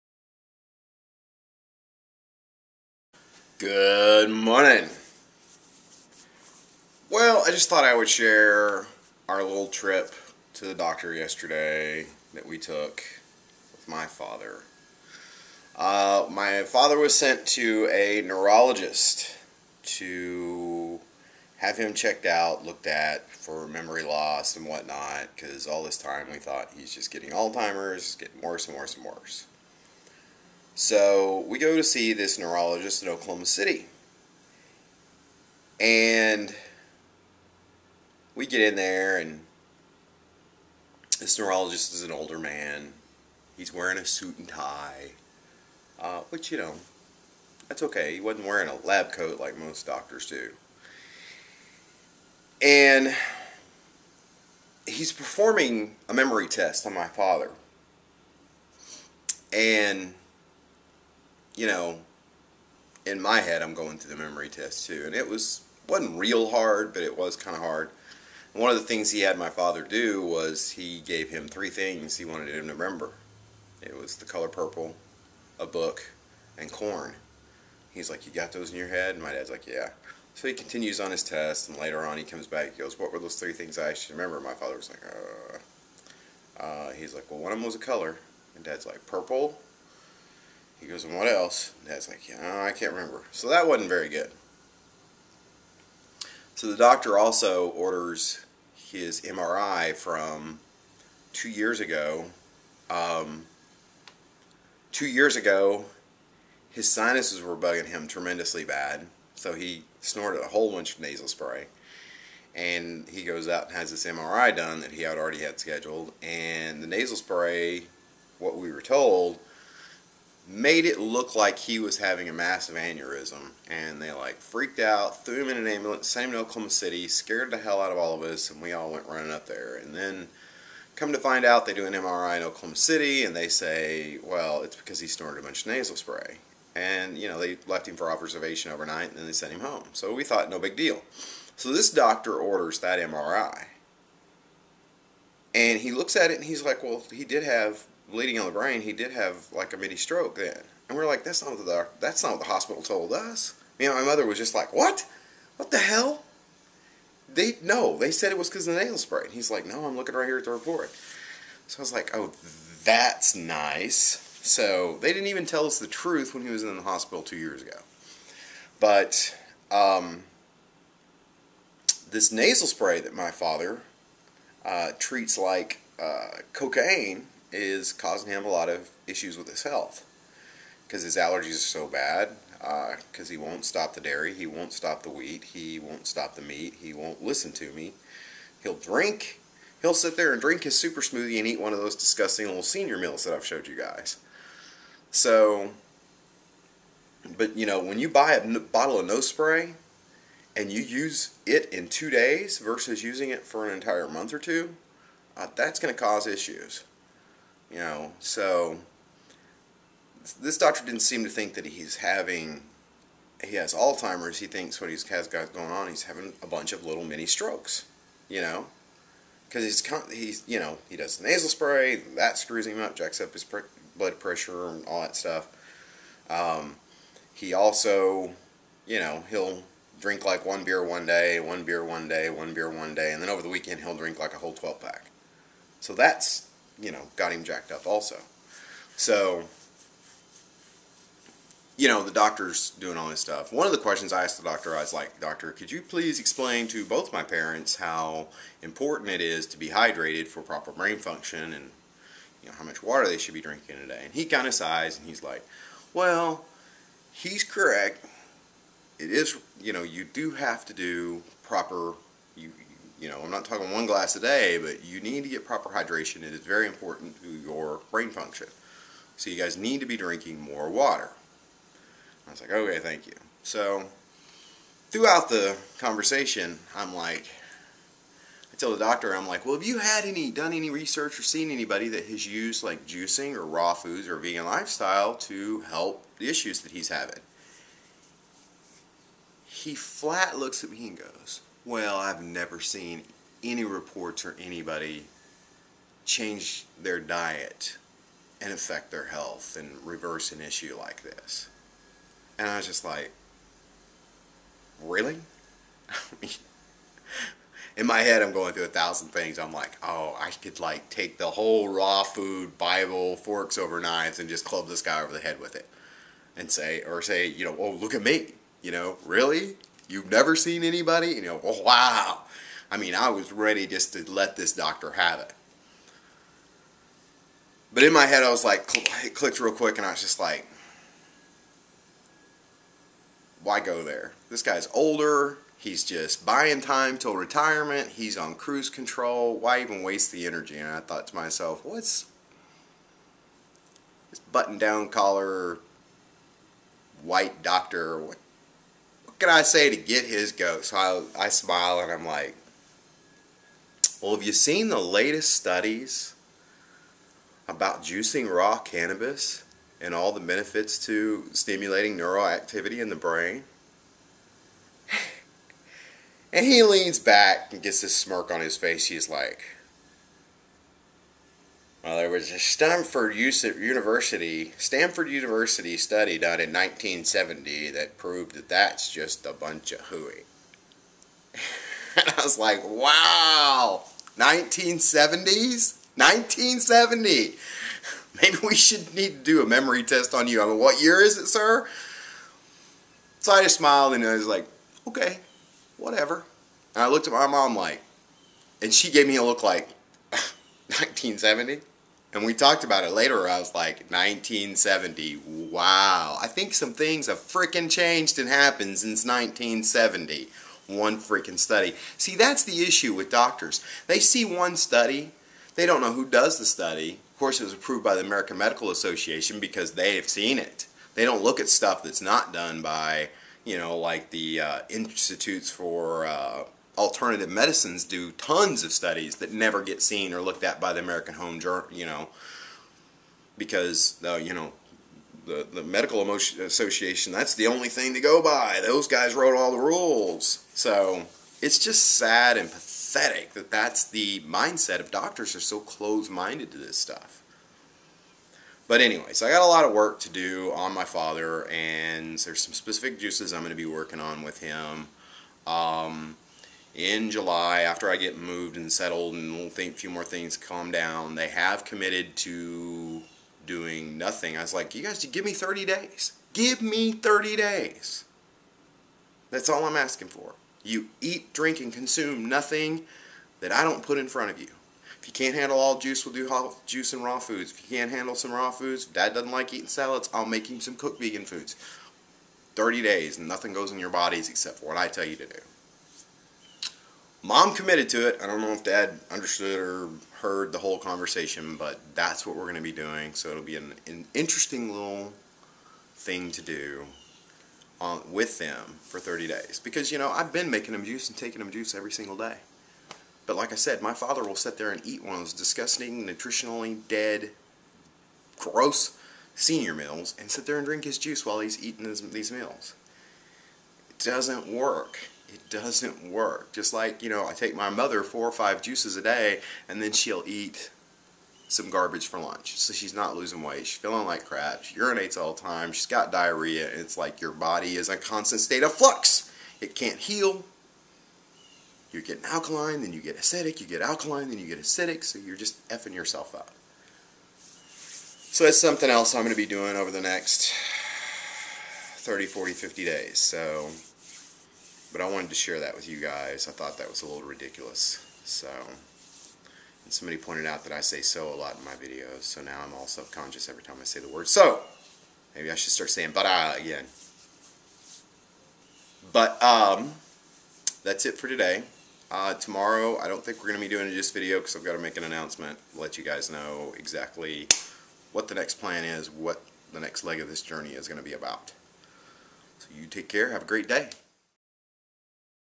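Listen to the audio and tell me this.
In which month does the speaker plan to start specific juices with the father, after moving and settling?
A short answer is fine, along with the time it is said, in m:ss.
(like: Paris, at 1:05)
July, at 7:37.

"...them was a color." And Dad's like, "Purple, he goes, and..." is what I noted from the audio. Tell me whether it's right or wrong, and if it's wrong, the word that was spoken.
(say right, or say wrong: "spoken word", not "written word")
right.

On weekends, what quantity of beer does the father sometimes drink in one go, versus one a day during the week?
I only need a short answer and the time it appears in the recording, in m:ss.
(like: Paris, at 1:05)
12 pack, at 3:54.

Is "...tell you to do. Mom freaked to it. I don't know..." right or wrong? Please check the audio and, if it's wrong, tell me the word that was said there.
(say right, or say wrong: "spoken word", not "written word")
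wrong: "committed", not "freaked".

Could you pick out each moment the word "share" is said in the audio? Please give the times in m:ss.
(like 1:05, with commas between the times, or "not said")
0:08, 9:05.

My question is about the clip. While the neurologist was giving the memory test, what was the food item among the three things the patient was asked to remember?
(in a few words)
corn.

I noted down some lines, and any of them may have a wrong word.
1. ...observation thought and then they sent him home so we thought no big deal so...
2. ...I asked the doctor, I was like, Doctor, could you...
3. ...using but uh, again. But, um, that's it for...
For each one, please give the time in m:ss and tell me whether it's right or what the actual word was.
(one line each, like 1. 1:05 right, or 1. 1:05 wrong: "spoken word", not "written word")
1. 2:18 wrong: "overnight", not "thought"
2. 4:04 right
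3. 9:15 wrong: "saying", not "using".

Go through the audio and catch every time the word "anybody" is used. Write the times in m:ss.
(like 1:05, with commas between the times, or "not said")
4:41, 4:54, 5:20.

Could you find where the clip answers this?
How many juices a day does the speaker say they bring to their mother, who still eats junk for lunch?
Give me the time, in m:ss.
8:38.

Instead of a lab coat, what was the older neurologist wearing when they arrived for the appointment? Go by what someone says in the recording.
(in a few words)
suit and tie.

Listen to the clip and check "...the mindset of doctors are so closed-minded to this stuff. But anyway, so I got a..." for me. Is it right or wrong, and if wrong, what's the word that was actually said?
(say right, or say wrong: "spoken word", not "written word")
right.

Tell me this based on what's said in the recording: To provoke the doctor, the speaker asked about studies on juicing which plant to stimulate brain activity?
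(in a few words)
raw cannabis.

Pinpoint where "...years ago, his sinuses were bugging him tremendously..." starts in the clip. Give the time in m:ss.
1:45.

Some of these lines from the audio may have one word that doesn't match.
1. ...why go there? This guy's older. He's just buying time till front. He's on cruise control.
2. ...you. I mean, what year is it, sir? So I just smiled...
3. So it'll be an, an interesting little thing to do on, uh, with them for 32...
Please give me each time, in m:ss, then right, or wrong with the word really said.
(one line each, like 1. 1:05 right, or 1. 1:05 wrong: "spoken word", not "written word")
1. 5:33 wrong: "retirement", not "front"
2. 6:30 right
3. 8:13 wrong: "30", not "32".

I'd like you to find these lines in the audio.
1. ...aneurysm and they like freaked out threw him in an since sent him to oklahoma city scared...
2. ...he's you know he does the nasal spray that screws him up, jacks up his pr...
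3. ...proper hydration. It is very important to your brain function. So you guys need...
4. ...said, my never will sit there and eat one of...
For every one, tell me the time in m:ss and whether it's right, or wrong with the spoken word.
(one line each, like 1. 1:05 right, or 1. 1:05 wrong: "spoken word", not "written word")
1. 2:02 wrong: "ambulance", not "since"
2. 3:40 right
3. 4:25 right
4. 8:23 wrong: "father", not "never".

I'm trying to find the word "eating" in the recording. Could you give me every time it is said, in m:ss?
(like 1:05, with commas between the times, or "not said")
7:59, 8:31.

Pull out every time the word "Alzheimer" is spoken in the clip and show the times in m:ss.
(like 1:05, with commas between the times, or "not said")
0:27, 3:33.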